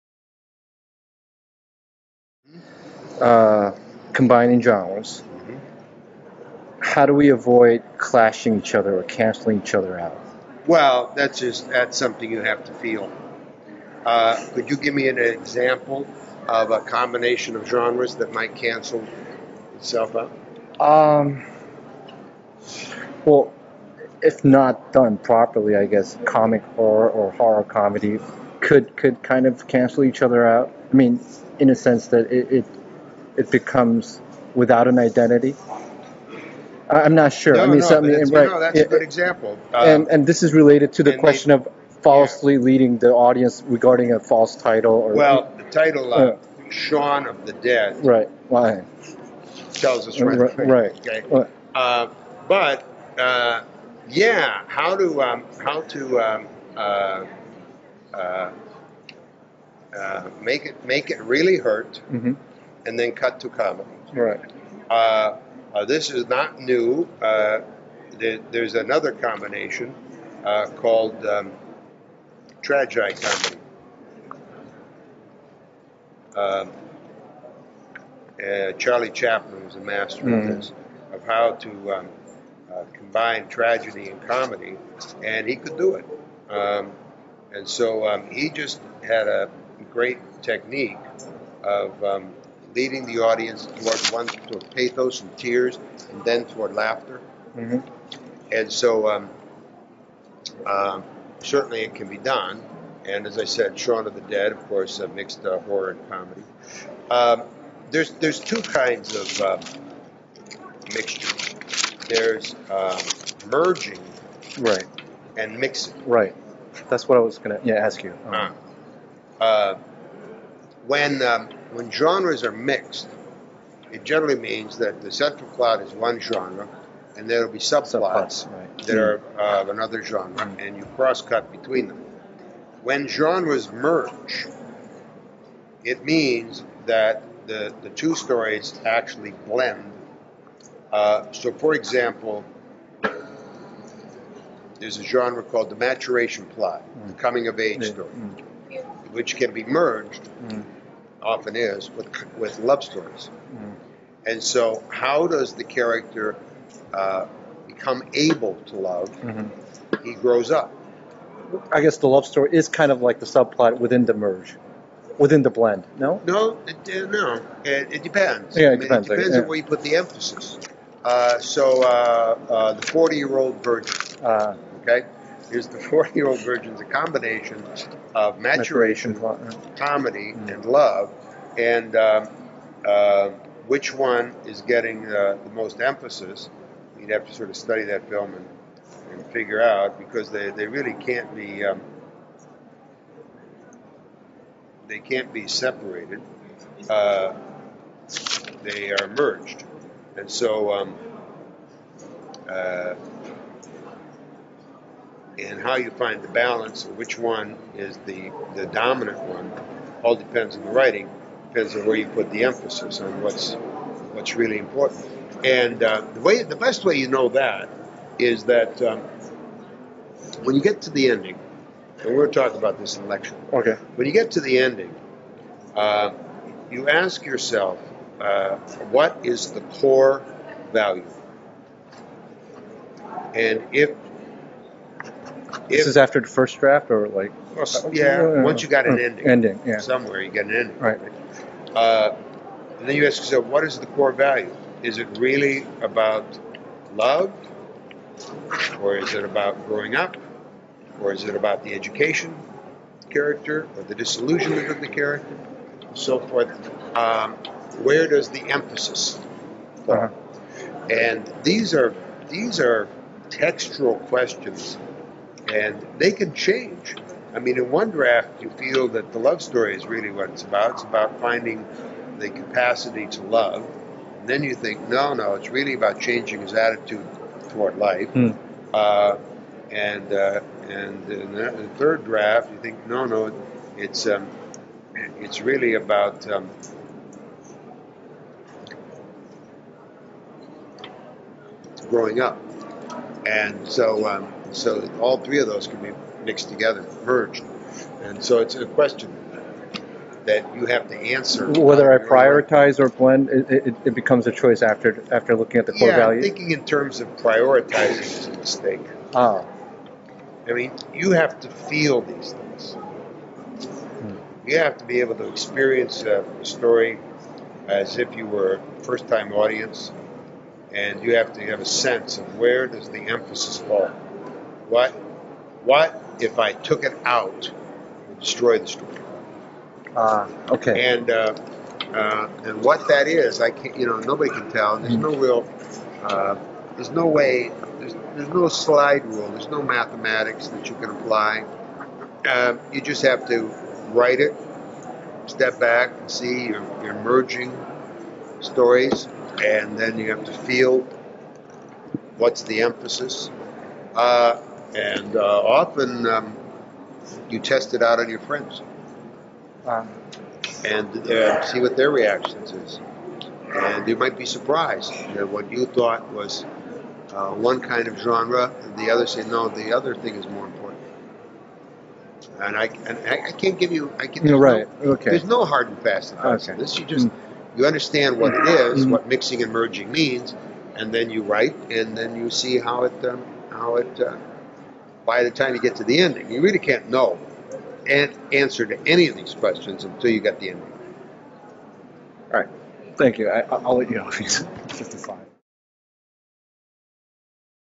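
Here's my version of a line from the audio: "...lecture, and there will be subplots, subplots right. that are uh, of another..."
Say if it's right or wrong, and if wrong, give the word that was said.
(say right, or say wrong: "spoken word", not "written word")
wrong: "genre", not "lecture".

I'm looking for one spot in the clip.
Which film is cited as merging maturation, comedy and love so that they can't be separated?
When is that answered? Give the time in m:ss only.
2:52.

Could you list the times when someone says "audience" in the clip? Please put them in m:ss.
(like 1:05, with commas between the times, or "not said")
0:43, 1:33, 5:19.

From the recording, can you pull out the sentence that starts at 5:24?
What, what if I took it out and destroyed the story?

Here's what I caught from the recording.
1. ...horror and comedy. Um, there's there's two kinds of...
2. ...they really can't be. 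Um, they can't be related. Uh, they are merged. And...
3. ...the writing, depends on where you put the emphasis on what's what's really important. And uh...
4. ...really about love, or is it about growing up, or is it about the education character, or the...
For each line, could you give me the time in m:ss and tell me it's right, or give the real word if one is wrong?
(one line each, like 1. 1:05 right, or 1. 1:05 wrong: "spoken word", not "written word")
1. 1:45 right
2. 3:10 wrong: "separated", not "related"
3. 3:30 right
4. 4:05 right.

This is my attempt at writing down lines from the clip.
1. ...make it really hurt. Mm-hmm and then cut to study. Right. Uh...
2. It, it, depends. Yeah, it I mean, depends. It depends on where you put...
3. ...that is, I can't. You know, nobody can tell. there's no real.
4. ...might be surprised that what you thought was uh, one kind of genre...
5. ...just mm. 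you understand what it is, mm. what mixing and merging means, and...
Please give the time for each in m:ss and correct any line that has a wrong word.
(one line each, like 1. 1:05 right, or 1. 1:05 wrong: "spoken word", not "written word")
1. 1:00 wrong: "comedy", not "study"
2. 2:47 right
3. 5:32 right
4. 6:03 right
5. 6:16 right.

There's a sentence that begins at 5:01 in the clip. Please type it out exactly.
Whether I prioritize or blend, it, it, it, becomes a choice after after looking at the core yeah, values.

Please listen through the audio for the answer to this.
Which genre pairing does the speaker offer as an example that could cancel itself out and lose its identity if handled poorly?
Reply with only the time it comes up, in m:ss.
0:27.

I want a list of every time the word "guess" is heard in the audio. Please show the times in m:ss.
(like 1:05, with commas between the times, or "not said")
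0:25, 2:41.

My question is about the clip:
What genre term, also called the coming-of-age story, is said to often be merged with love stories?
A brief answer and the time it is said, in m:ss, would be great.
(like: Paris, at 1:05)
maturation plot, at 2:25.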